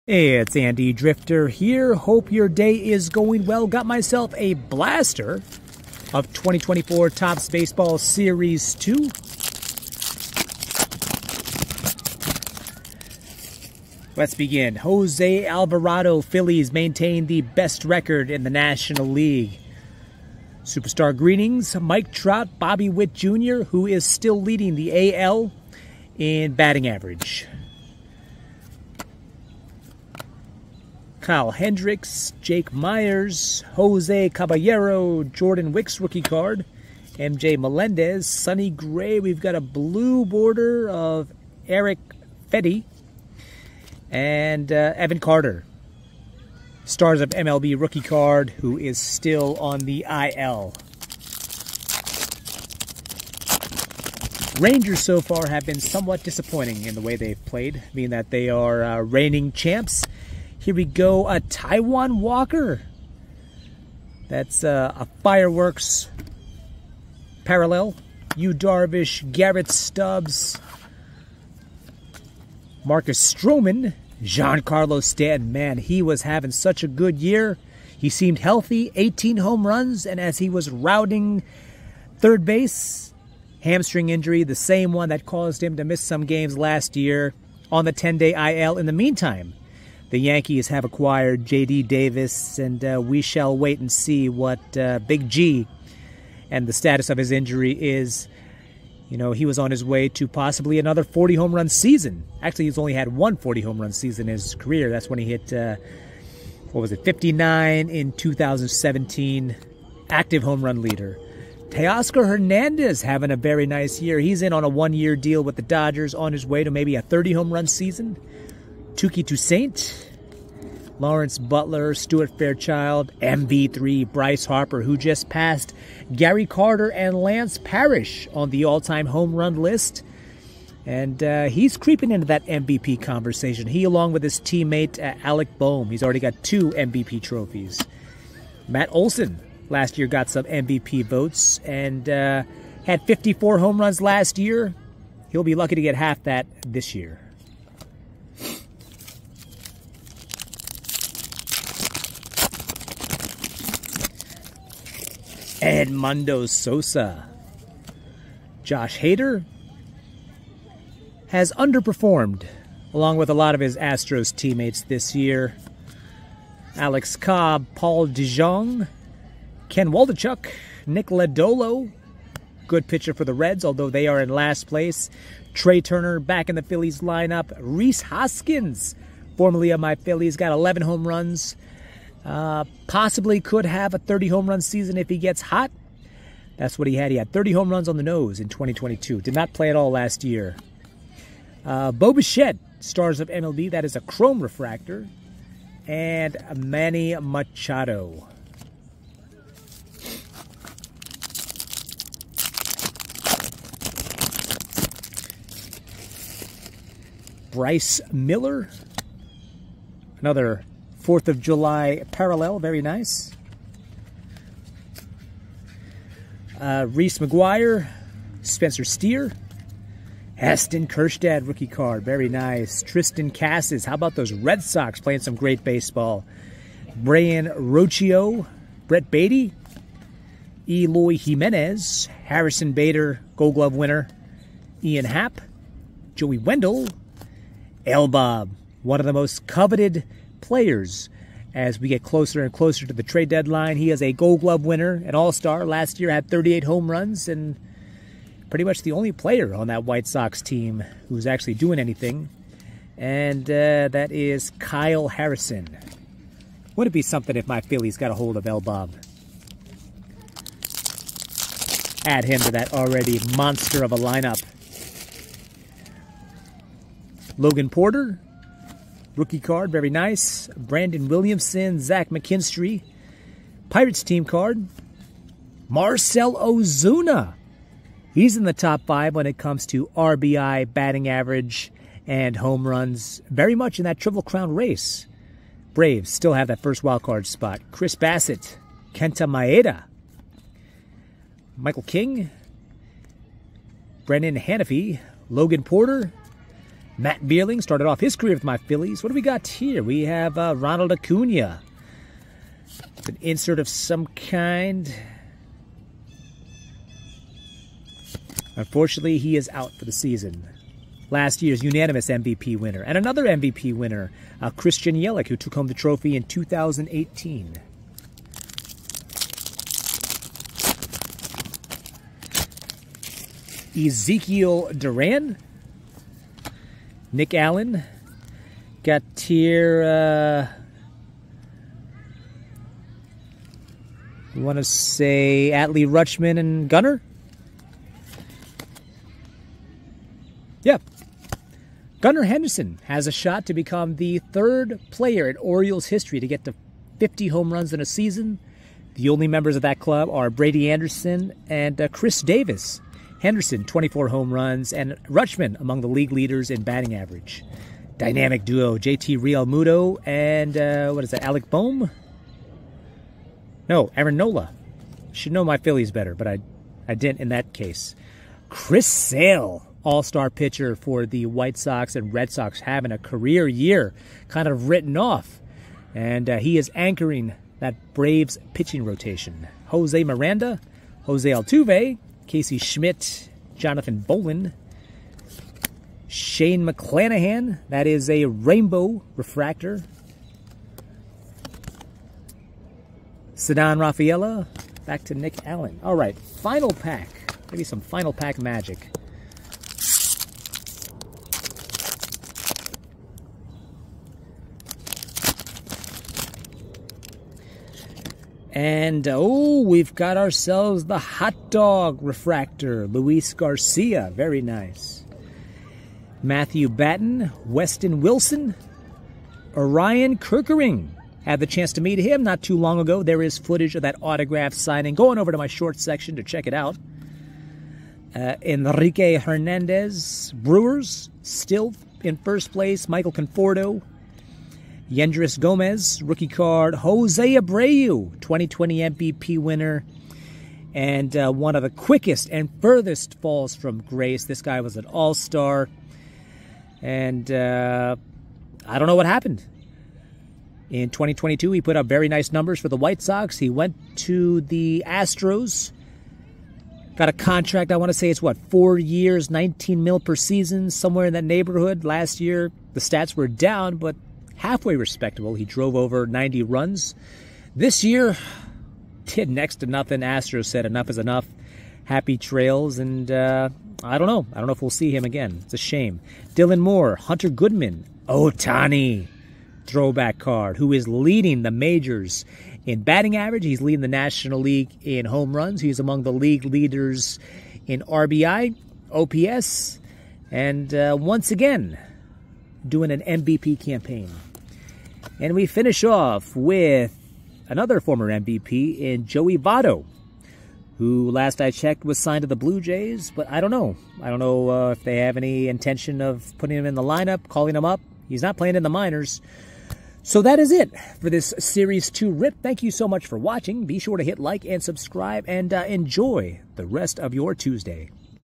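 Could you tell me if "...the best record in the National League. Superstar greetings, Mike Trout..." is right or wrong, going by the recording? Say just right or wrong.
right.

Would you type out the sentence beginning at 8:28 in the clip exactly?
He's not playing in the minors.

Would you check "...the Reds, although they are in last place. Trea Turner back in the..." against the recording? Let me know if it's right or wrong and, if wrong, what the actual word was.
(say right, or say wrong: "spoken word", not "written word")
right.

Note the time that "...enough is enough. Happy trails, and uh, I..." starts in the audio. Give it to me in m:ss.
7:50.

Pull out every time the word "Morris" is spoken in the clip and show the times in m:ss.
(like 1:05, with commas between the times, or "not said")
not said.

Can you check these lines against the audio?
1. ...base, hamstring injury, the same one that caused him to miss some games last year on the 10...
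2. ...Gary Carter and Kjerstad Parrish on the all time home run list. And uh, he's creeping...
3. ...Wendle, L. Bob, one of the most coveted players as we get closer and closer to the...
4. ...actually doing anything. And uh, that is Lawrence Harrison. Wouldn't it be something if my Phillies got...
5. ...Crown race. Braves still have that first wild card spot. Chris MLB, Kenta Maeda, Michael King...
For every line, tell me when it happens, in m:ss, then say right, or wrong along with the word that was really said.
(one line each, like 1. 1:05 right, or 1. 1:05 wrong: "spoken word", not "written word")
1. 1:22 right
2. 2:06 wrong: "Lance", not "Kjerstad"
3. 3:56 right
4. 4:11 wrong: "Kyle", not "Lawrence"
5. 4:44 wrong: "Bassitt", not "MLB".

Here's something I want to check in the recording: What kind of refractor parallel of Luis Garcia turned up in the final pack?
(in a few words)
hot dog refractor.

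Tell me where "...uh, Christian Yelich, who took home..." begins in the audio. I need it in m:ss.
5:14.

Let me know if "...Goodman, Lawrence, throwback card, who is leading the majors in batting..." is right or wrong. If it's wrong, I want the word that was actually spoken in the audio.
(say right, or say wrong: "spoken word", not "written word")
wrong: "Ohtani", not "Lawrence".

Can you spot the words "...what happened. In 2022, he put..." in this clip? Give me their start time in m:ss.
7:28.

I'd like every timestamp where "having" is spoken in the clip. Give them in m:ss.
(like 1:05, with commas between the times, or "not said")
1:16, 1:53, 6:12.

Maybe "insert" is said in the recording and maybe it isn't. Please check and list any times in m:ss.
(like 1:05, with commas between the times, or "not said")
5:03.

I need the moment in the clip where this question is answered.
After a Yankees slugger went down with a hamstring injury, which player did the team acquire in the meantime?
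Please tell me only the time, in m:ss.
1:31.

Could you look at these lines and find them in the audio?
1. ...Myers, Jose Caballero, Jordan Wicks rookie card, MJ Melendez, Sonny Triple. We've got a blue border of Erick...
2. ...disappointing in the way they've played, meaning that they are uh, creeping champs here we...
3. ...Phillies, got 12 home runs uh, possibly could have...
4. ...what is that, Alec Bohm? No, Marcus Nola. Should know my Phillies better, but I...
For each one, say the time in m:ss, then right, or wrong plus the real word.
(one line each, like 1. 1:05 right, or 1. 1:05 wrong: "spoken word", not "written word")
1. 0:32 wrong: "Gray", not "Triple"
2. 0:56 wrong: "reigning", not "creeping"
3. 2:59 wrong: "11", not "12"
4. 6:00 wrong: "Aaron", not "Marcus".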